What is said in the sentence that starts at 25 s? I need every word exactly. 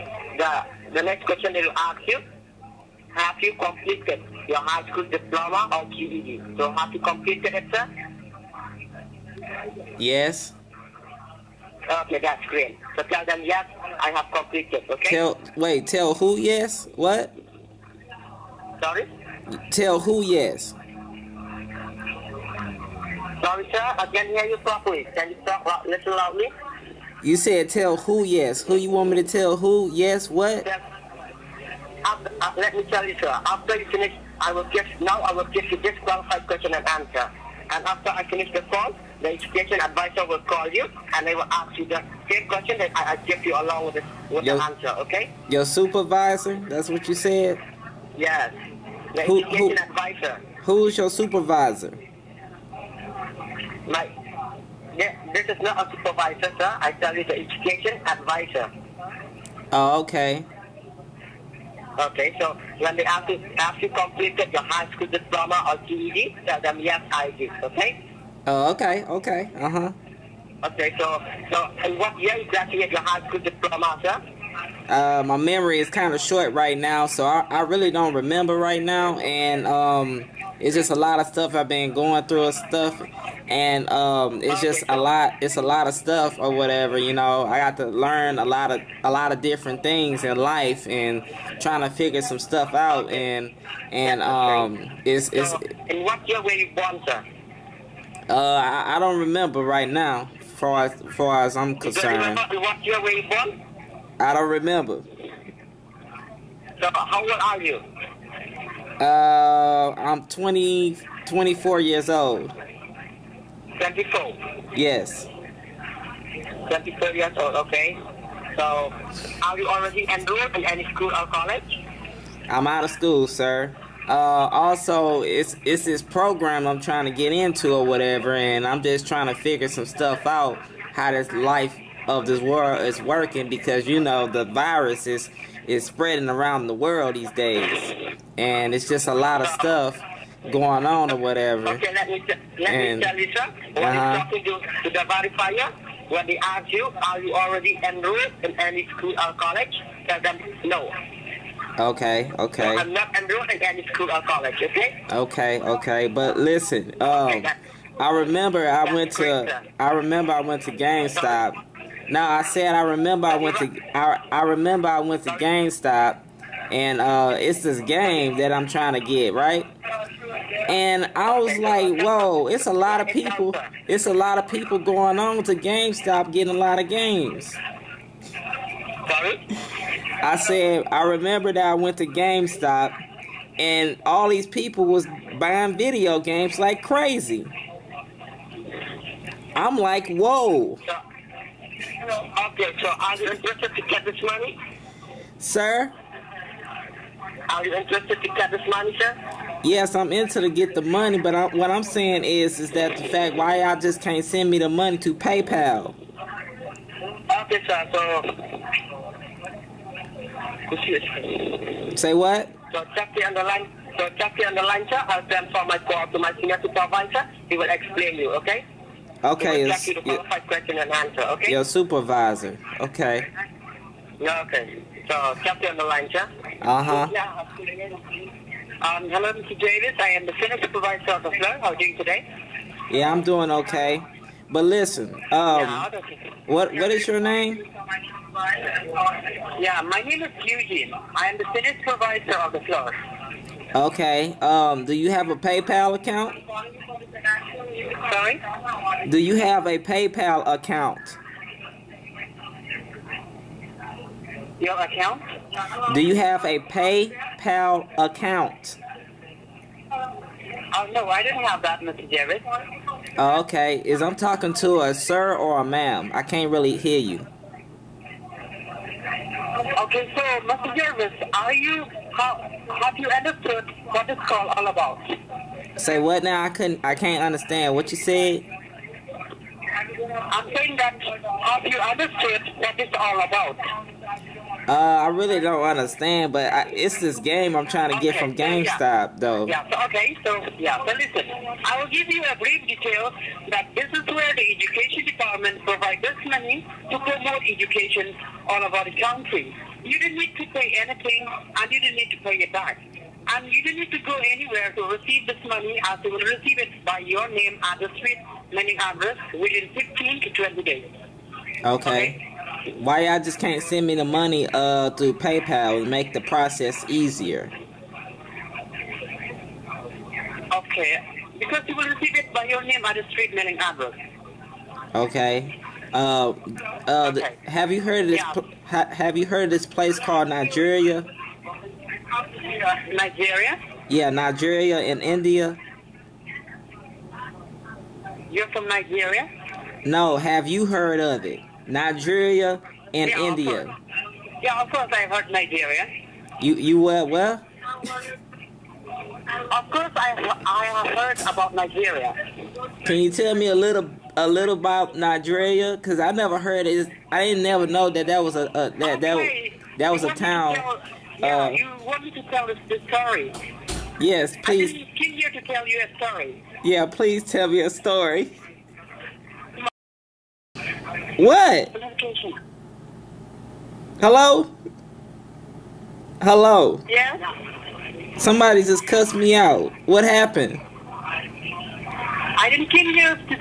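Can you talk a little loudly?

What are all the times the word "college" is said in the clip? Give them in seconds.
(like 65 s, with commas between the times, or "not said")
121 s, 149 s, 154 s.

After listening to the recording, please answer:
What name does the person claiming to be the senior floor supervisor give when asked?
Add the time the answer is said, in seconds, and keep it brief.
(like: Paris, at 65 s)
Eugene, at 240 s.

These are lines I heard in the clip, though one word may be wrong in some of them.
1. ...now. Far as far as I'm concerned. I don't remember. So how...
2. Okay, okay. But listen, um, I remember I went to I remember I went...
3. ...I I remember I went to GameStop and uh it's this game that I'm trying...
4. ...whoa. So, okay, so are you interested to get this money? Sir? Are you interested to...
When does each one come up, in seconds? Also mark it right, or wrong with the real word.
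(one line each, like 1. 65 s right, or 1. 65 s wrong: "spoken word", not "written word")
1. 99 s right
2. 155 s right
3. 163 s right
4. 190 s right.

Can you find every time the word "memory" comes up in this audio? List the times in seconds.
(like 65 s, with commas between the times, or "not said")
75 s.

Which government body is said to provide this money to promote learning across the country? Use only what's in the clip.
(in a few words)
Education Department.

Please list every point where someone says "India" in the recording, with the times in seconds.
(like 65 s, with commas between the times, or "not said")
335 s, 343 s.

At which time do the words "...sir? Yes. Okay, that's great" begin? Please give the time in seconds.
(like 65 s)
7 s.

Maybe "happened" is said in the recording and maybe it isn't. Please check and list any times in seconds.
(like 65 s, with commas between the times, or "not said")
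380 s.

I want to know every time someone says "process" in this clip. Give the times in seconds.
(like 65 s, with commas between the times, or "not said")
316 s.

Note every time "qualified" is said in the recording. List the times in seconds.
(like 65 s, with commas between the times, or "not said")
36 s, 220 s.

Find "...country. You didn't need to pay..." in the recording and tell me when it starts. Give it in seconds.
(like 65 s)
299 s.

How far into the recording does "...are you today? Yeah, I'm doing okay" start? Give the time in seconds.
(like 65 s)
231 s.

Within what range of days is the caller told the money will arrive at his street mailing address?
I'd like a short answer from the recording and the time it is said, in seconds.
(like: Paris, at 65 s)
15 to 20 days, at 309 s.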